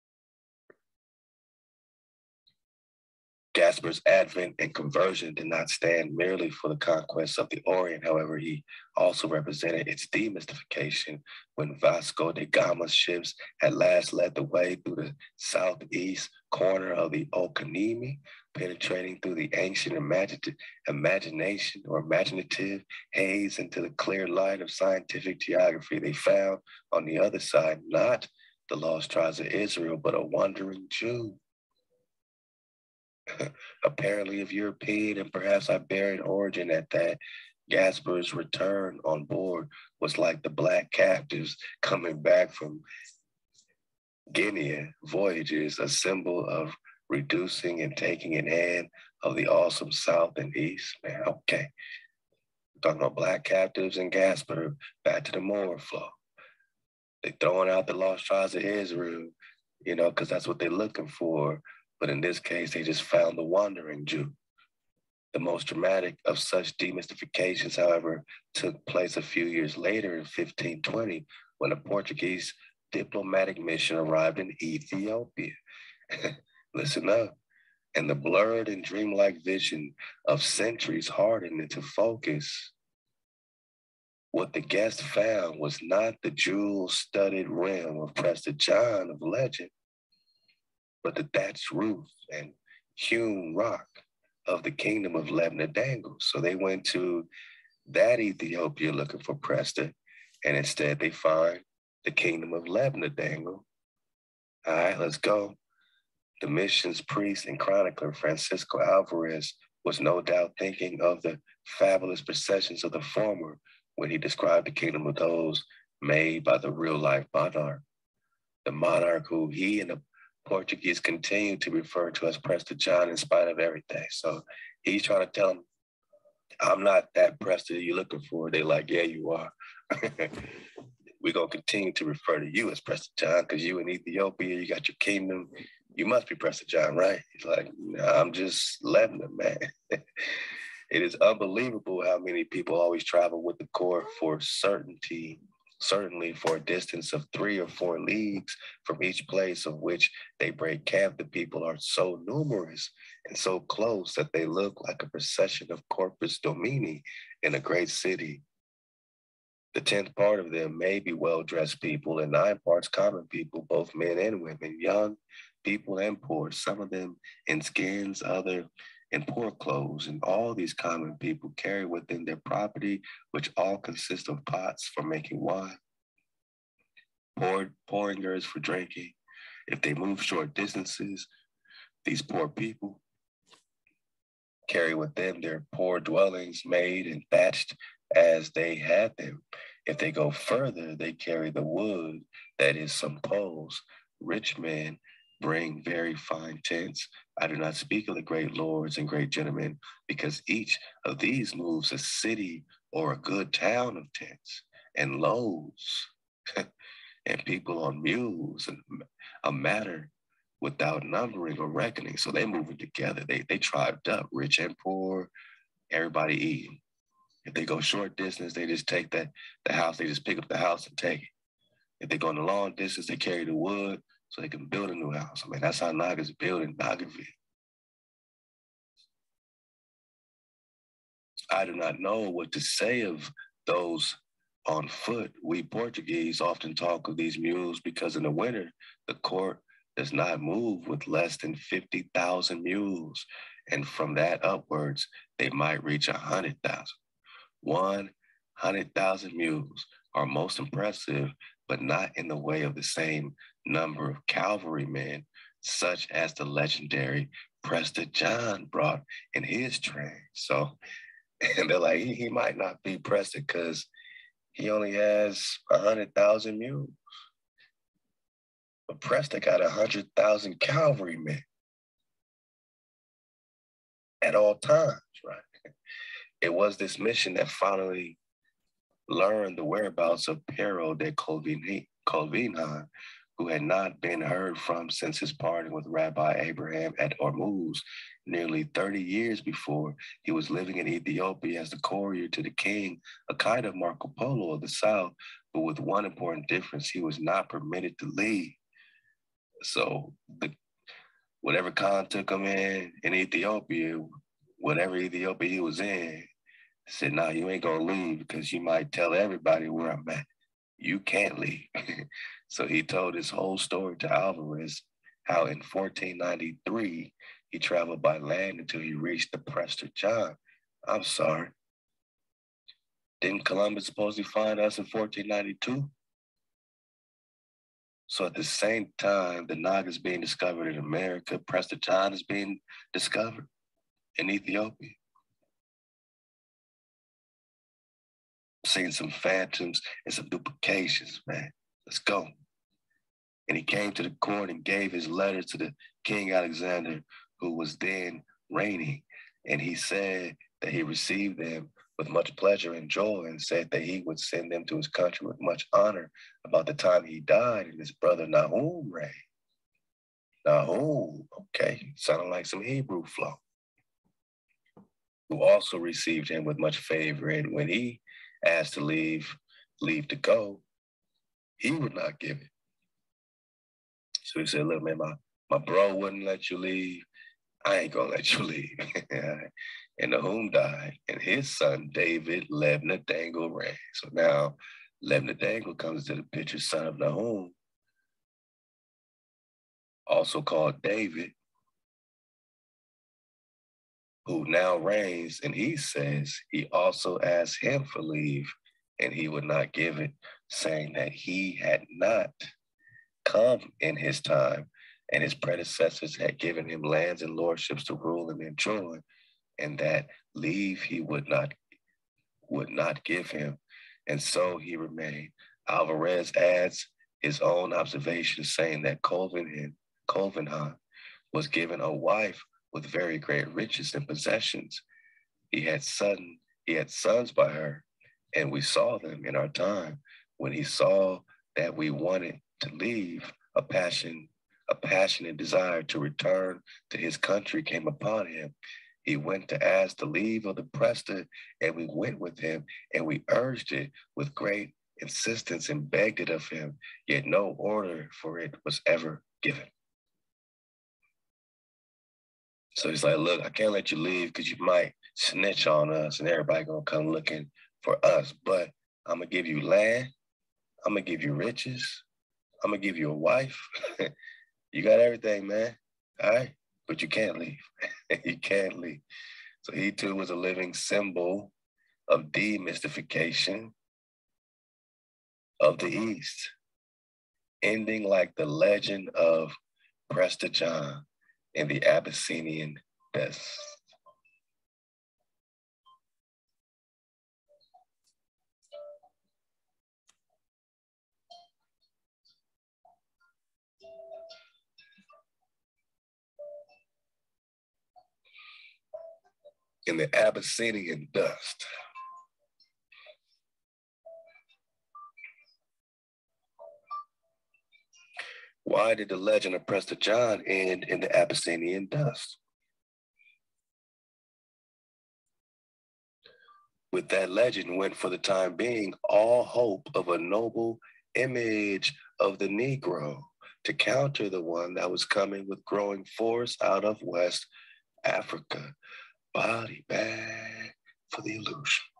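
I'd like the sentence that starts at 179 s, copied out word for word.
If they move short distances, these poor people carry with them their poor dwellings made and thatched as they had them.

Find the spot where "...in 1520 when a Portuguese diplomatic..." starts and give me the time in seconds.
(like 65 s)
70 s.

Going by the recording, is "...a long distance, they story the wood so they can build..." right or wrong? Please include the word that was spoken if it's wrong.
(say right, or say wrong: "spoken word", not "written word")
wrong: "carry", not "story".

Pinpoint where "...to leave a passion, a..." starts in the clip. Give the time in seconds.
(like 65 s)
432 s.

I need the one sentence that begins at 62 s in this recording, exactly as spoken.
But in this case, they just found the wandering Jew.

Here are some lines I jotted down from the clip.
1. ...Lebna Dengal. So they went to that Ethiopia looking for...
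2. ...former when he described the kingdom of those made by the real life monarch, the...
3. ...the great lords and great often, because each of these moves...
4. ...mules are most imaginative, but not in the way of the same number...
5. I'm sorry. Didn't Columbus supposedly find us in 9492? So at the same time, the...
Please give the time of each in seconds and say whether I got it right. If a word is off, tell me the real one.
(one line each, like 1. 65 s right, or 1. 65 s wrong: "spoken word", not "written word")
1. 95 s right
2. 113 s right
3. 198 s wrong: "gentlemen", not "often"
4. 249 s wrong: "impressive", not "imaginative"
5. 320 s wrong: "1492", not "9492".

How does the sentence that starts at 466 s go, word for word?
All right, but you can't leave.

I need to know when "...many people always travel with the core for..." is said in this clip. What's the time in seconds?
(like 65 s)
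142 s.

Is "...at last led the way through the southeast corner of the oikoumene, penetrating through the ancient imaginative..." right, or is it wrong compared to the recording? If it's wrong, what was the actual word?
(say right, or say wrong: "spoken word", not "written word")
right.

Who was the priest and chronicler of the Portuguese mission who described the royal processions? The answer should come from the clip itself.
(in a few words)
Francisco Alvarez.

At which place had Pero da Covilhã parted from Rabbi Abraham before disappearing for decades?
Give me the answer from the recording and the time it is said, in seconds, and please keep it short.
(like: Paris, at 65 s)
Ormuz, at 287 s.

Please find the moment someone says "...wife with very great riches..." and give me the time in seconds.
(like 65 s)
421 s.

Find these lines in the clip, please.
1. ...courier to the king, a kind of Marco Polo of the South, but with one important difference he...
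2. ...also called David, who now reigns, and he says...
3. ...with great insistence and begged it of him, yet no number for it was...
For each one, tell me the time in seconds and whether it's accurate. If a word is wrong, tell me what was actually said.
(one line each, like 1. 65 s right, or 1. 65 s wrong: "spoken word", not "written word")
1. 291 s right
2. 390 s right
3. 444 s wrong: "order", not "number".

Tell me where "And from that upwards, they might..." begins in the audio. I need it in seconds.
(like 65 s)
243 s.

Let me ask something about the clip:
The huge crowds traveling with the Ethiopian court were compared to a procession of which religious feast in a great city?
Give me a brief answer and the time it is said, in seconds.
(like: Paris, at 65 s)
Corpus Domini, at 155 s.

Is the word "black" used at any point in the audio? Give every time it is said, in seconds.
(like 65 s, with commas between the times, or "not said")
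40 s, 53 s.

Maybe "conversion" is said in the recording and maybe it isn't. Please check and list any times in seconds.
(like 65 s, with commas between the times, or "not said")
4 s.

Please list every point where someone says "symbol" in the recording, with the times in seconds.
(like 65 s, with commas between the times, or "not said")
45 s, 470 s.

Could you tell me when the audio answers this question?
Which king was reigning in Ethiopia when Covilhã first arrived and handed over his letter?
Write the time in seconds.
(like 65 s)
346 s.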